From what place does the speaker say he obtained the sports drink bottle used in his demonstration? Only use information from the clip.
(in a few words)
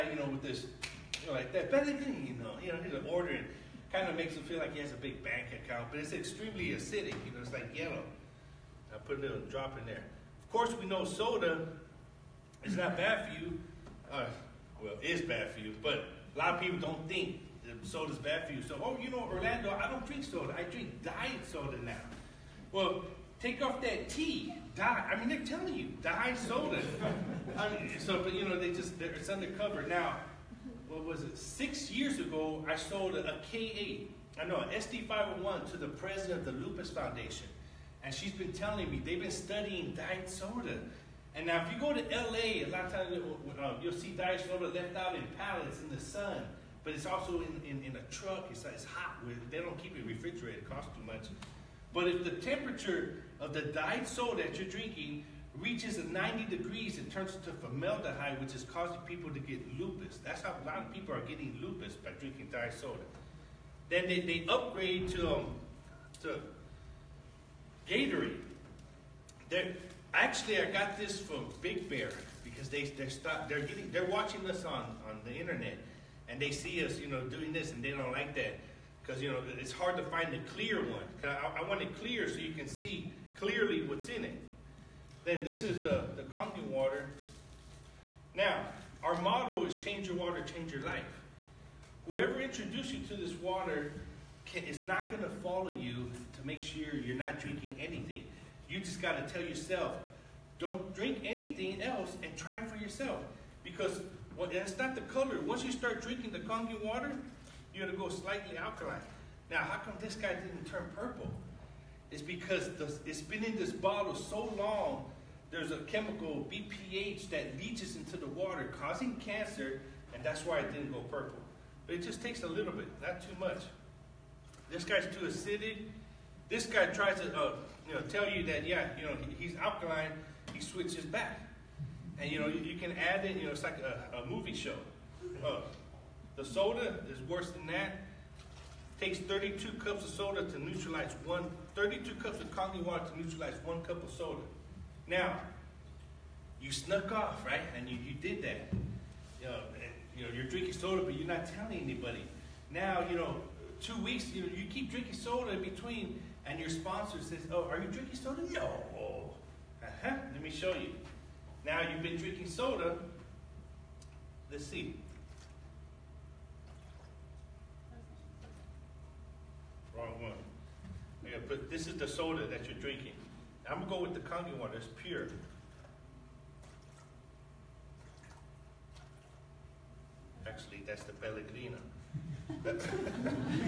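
Big Bear.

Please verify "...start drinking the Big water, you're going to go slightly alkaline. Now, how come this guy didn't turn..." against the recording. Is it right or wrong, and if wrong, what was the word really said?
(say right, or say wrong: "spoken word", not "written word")
wrong: "Kangen", not "Big".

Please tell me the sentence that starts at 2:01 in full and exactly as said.
But it just takes a little bit, not too much.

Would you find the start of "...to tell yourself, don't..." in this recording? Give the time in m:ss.
1:39.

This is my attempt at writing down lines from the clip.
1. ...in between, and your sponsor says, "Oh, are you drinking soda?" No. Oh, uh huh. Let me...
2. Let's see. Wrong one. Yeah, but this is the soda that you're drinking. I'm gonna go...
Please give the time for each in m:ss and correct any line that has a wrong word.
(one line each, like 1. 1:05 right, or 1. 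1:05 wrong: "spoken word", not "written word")
1. 2:35 right
2. 2:44 right.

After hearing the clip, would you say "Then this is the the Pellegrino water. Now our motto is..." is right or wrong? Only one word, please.
wrong.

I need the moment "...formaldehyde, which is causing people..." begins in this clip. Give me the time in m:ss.
0:57.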